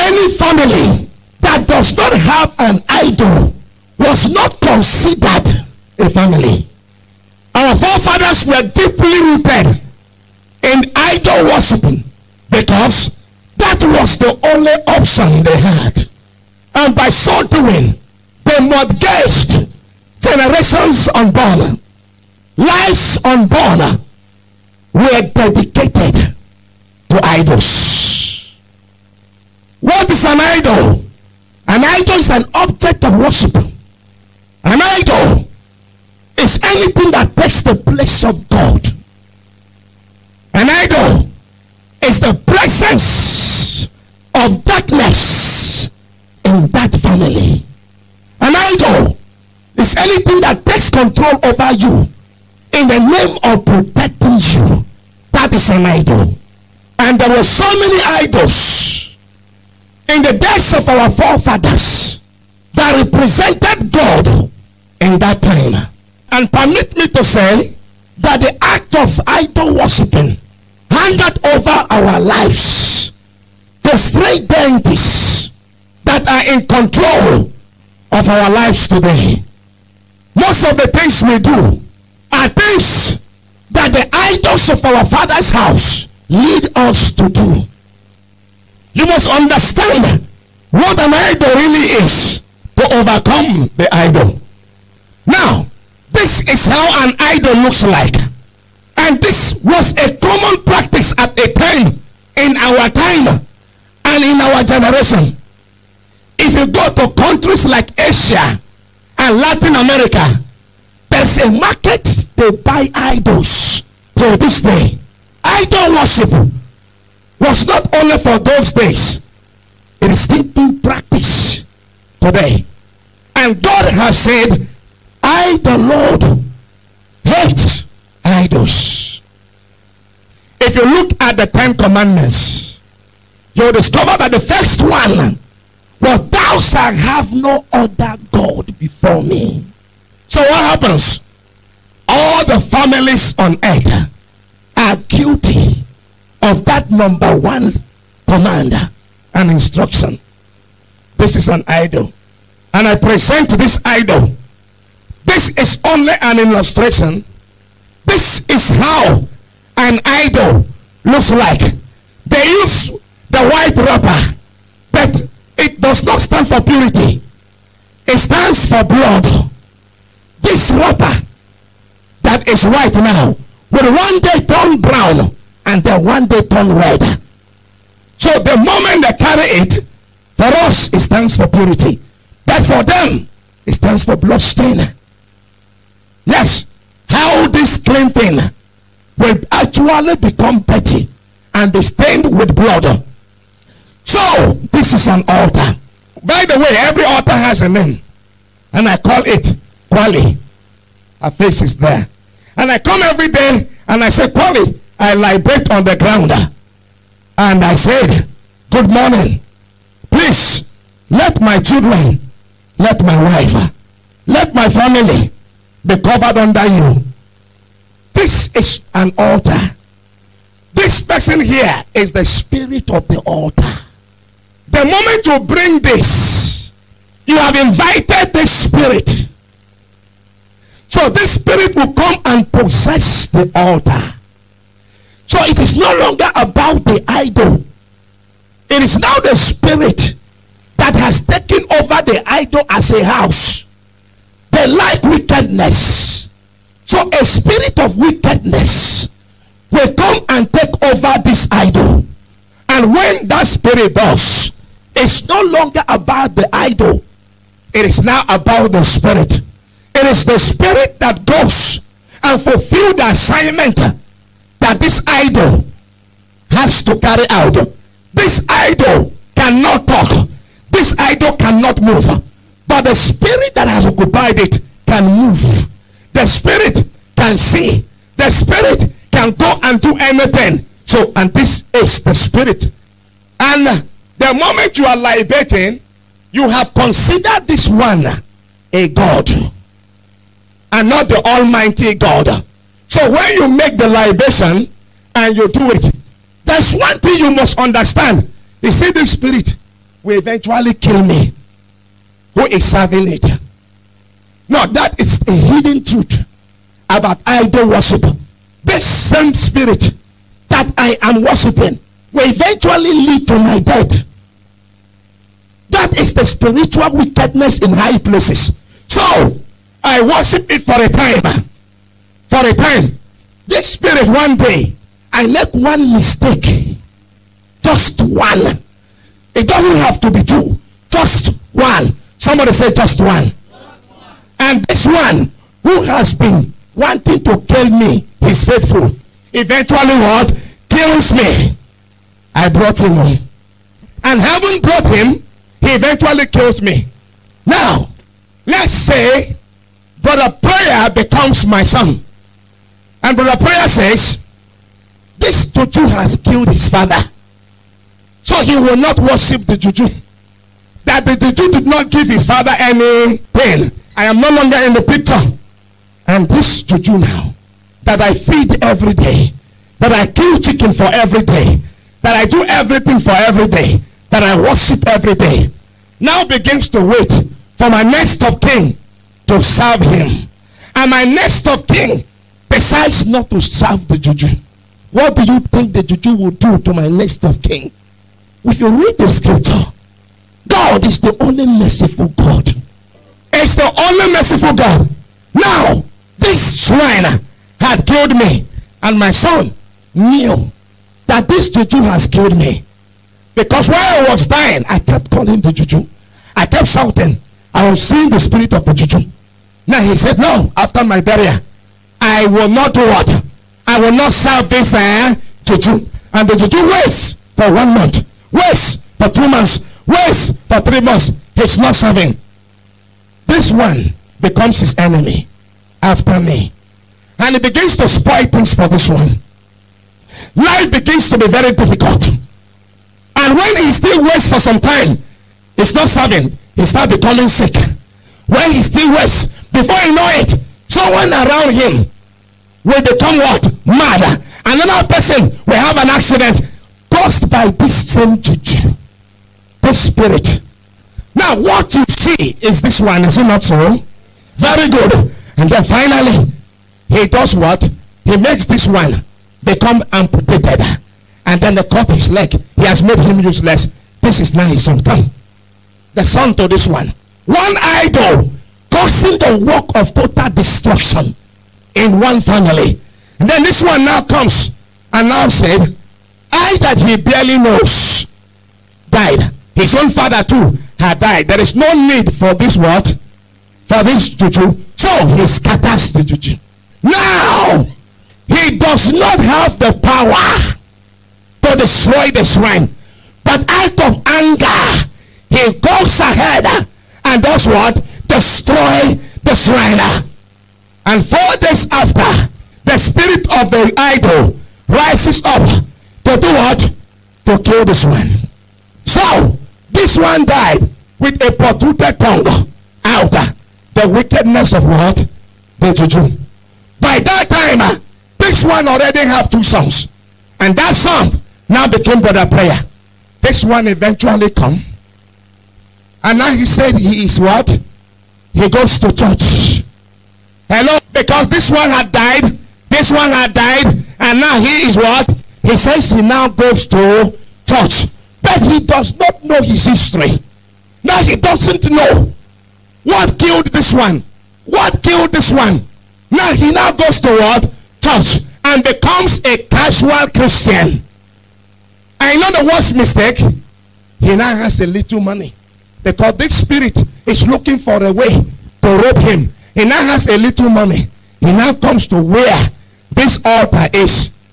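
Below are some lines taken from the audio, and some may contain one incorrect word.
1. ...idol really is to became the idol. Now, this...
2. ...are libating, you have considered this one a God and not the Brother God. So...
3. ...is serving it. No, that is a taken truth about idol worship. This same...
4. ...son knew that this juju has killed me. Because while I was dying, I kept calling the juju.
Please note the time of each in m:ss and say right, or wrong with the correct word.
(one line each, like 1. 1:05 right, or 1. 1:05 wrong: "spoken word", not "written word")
1. 1:31 wrong: "overcome", not "became"
2. 4:44 wrong: "Almighty", not "Brother"
3. 5:02 wrong: "hidden", not "taken"
4. 6:39 right.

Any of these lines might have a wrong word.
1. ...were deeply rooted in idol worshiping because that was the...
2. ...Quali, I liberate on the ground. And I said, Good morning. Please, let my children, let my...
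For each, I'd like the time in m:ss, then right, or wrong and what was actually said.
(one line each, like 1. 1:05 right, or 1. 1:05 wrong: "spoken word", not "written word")
1. 0:08 right
2. 3:24 right.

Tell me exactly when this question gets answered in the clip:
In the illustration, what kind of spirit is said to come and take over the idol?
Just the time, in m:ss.
4:07.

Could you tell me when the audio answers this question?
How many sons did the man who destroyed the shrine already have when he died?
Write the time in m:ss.
8:39.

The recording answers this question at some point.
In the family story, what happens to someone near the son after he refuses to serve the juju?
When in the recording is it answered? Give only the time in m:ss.
7:23.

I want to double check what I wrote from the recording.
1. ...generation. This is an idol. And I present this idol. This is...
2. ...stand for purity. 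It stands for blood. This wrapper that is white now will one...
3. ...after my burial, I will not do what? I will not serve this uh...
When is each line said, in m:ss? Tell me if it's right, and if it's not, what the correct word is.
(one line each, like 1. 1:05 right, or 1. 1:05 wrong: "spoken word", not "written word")
1. 2:29 wrong: "instruction", not "generation"
2. 2:46 right
3. 6:50 right.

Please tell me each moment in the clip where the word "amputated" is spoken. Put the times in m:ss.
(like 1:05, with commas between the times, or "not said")
7:39.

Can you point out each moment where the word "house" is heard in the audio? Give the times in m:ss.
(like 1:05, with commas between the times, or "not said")
1:25, 4:03.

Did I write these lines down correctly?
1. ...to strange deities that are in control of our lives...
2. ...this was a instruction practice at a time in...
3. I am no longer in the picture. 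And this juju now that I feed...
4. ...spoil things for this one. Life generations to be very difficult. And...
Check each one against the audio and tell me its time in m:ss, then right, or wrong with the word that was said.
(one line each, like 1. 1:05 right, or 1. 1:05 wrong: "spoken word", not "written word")
1. 1:13 right
2. 1:39 wrong: "common", not "instruction"
3. 6:03 right
4. 7:07 wrong: "begins", not "generations".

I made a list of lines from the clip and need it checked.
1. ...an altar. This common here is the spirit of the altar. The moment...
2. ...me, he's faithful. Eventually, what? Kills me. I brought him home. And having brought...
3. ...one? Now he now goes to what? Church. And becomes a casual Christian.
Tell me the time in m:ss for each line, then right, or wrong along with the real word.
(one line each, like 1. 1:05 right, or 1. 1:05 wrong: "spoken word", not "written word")
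1. 3:38 wrong: "person", not "common"
2. 5:37 right
3. 9:05 right.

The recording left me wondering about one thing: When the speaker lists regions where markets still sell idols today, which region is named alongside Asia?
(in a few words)
Latin America.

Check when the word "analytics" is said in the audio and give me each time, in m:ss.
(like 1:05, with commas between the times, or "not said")
not said.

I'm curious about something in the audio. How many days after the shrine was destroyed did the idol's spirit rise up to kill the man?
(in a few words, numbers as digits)
4.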